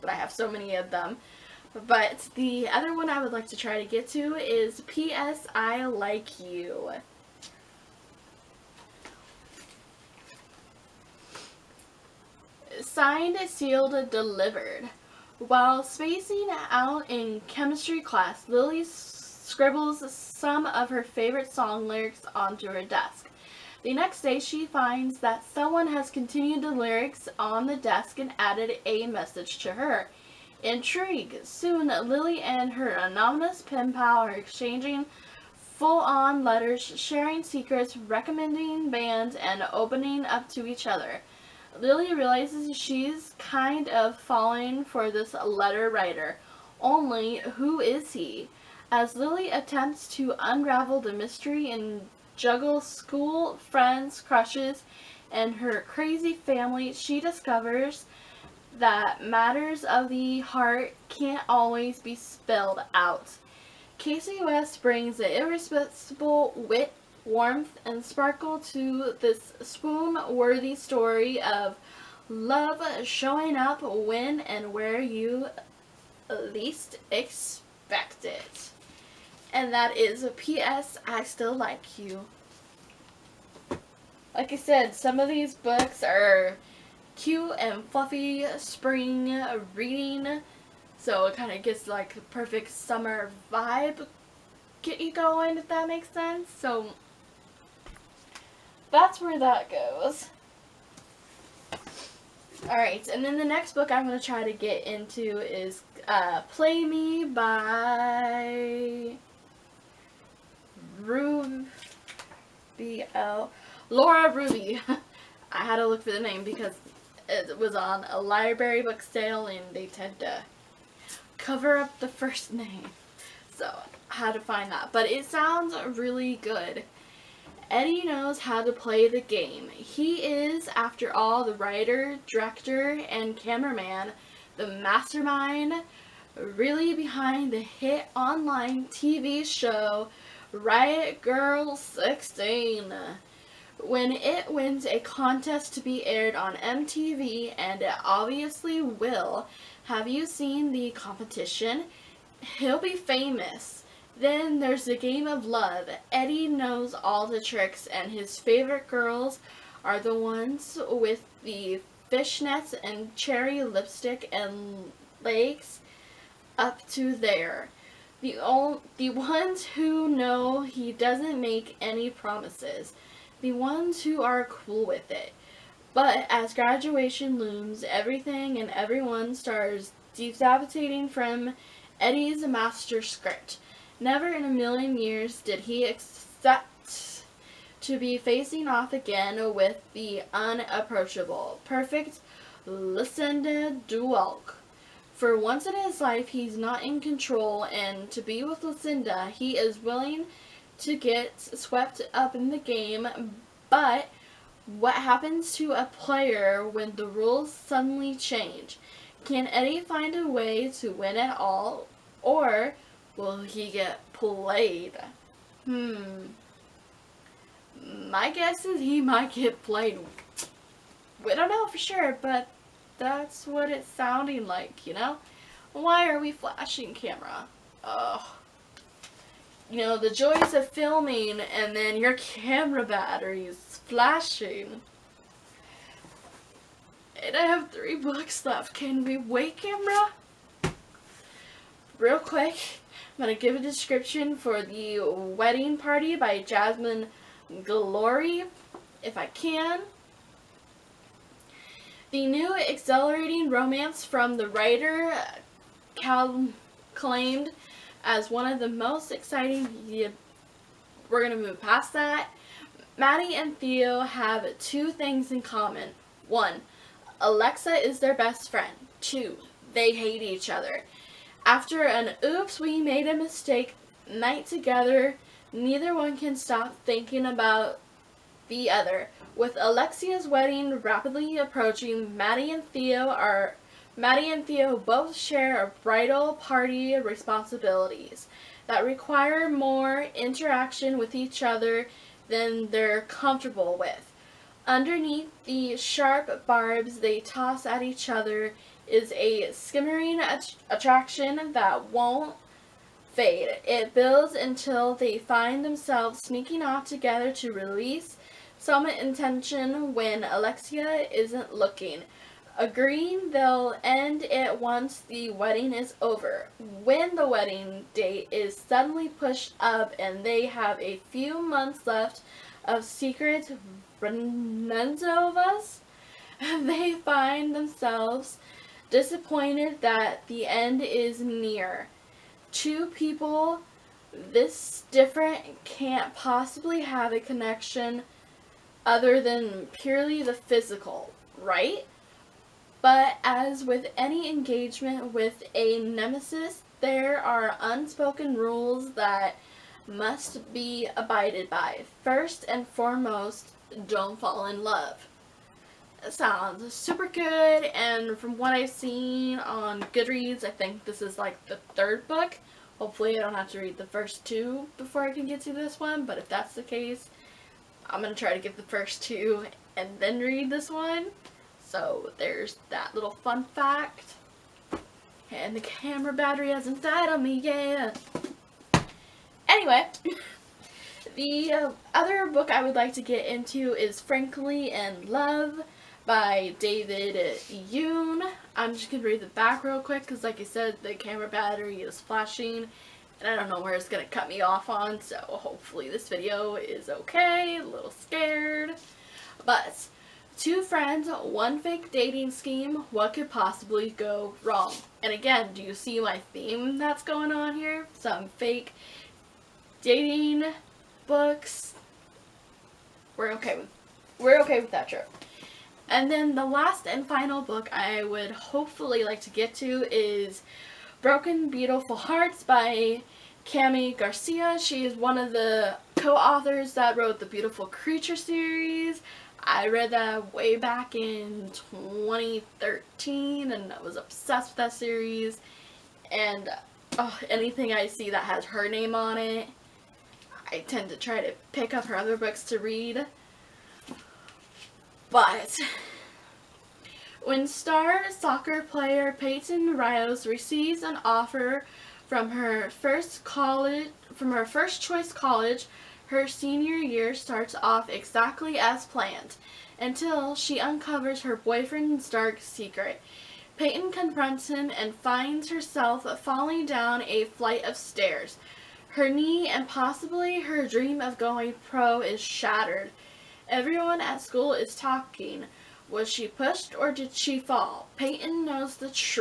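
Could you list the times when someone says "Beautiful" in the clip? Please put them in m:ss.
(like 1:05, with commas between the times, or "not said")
7:01, 7:07.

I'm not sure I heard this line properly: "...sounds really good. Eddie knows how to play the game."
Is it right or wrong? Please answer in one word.
right.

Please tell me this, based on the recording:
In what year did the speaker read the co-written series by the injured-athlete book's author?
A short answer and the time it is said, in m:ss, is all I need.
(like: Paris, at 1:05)
2013, at 7:11.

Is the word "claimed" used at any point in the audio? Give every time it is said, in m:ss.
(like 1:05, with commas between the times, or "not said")
4:16.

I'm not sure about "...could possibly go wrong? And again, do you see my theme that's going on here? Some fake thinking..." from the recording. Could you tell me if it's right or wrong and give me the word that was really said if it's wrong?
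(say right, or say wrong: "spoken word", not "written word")
wrong: "dating", not "thinking".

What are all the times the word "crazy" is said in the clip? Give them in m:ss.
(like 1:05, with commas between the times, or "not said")
0:55.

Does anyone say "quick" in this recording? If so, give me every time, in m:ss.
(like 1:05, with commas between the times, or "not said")
4:02, 6:29.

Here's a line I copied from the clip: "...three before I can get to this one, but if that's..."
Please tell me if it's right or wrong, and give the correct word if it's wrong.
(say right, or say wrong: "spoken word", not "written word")
wrong: "two", not "three".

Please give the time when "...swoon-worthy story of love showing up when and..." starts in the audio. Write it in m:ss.
1:09.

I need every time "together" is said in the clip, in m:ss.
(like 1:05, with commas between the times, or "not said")
4:34, 5:06.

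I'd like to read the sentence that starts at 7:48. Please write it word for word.
Her knee and possibly her dream of going pro is shattered.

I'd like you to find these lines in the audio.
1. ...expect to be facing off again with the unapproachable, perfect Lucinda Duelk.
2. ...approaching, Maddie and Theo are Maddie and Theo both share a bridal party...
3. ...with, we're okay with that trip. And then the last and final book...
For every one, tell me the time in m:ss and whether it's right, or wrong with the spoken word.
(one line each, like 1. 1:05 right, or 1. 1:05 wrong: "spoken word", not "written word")
1. 3:05 right
2. 4:41 right
3. 6:53 right.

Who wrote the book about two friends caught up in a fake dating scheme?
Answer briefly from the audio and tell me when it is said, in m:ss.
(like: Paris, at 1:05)
David Yoon, at 6:26.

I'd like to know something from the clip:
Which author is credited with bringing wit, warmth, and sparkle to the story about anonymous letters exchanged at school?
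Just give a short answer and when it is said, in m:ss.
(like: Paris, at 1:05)
Kasie West, at 1:03.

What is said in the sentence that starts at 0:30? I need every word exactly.
Intrigued, soon Lily and her anonymous pen pal are exchanging full-on letters, sharing secrets, recommending bands, and opening up to each other.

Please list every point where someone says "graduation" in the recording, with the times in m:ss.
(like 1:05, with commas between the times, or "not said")
2:56.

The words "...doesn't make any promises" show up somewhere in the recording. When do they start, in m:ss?
2:50.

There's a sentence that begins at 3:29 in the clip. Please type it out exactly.
Can Eddie find a way to win at all, or will he get played?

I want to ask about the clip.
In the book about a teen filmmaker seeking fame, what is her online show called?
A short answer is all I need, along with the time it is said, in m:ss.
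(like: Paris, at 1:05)
Riot Girl 16, at 2:20.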